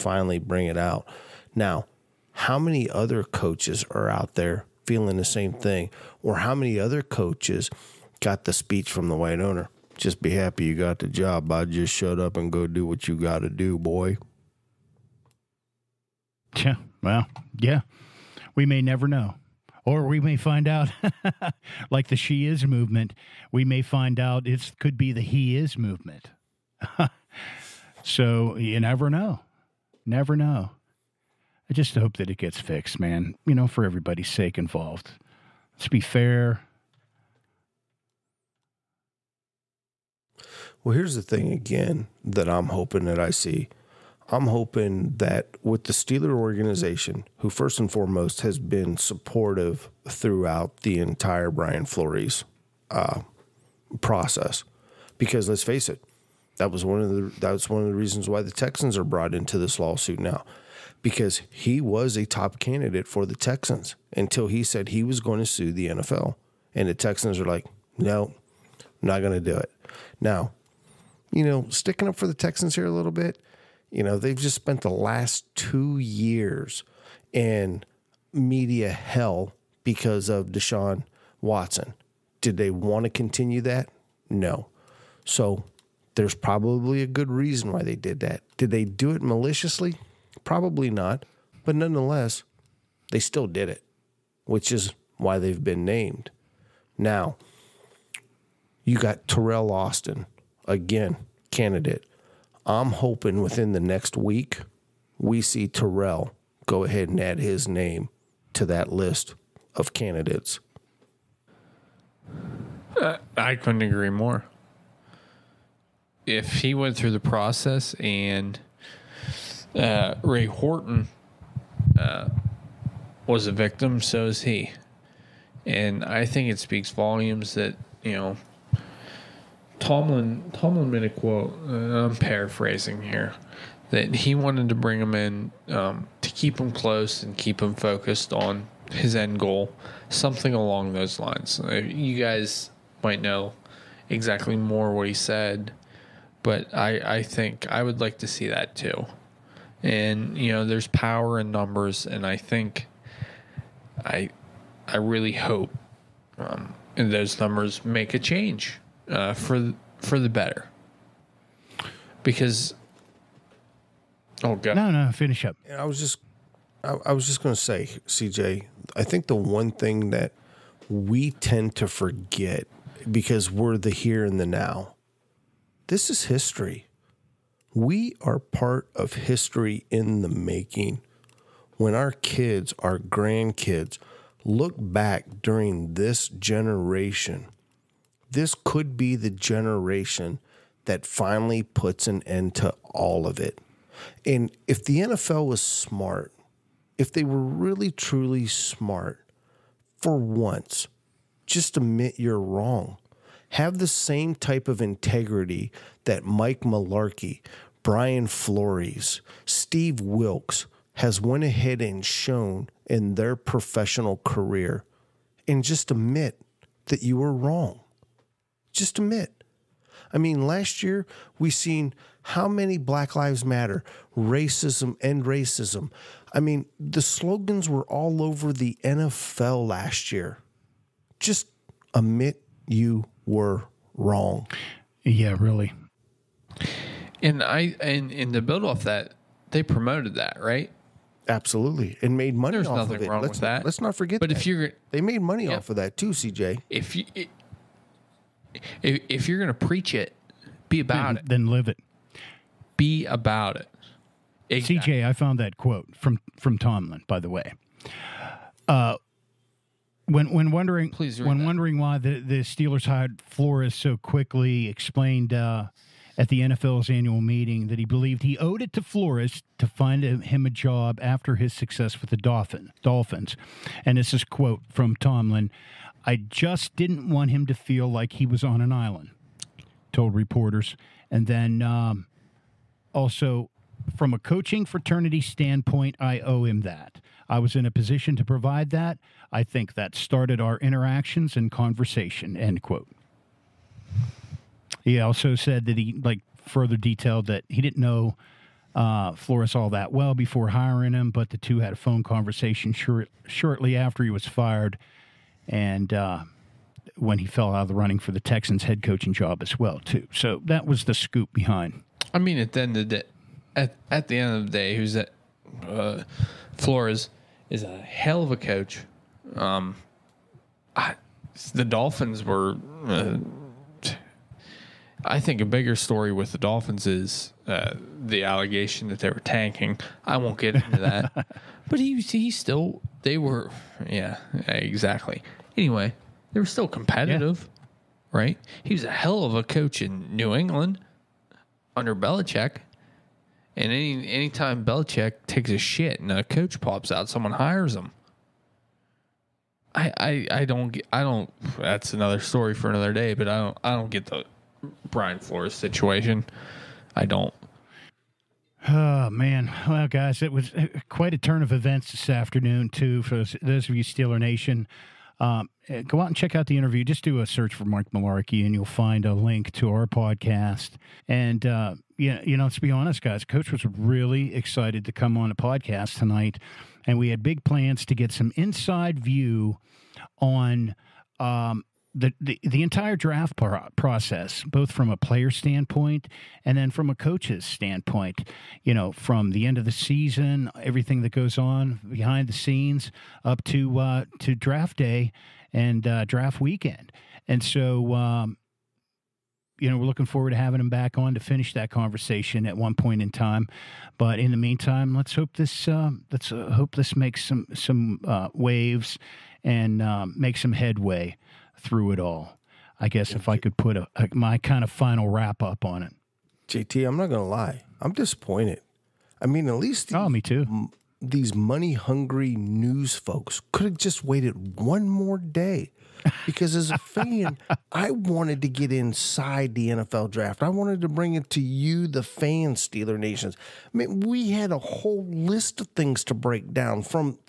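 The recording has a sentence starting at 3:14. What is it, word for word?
And if the NFL was smart, if they were really truly smart, for once, just admit you're wrong.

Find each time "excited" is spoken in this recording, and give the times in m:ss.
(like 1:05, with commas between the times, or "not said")
6:14.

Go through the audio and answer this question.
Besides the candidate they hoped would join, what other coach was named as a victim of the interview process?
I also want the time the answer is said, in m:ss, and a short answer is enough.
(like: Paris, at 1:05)
Ray Horton, at 2:00.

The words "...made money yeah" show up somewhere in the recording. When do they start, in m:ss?
4:04.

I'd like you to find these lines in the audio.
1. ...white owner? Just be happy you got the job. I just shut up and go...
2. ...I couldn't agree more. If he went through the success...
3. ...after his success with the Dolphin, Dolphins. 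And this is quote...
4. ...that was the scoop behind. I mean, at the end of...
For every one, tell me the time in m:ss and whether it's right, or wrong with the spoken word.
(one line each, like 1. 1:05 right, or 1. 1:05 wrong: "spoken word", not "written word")
1. 0:09 right
2. 1:53 wrong: "process", not "success"
3. 4:31 right
4. 5:10 right.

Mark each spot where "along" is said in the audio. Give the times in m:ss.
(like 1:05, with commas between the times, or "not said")
2:20.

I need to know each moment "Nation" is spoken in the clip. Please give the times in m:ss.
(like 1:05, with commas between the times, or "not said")
6:04, 7:12.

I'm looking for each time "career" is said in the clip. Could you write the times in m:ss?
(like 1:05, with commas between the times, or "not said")
3:34.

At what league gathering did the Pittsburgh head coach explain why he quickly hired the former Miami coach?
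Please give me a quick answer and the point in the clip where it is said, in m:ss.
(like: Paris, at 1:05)
NFL's annual meeting, at 4:26.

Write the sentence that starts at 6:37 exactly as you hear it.
And so, um, you know, we're looking forward to having him back on to finish that conversation at one point in time.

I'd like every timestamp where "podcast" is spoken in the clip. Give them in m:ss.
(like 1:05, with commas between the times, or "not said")
6:09, 6:15.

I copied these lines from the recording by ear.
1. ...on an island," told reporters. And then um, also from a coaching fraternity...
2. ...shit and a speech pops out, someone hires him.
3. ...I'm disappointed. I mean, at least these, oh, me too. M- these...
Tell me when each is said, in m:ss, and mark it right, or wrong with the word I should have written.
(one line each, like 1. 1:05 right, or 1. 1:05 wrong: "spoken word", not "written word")
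1. 4:38 right
2. 5:45 wrong: "coach", not "speech"
3. 6:57 right.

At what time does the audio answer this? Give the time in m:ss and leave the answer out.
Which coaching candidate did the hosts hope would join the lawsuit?
1:39.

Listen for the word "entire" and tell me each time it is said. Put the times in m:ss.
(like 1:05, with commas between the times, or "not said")
0:50, 6:22.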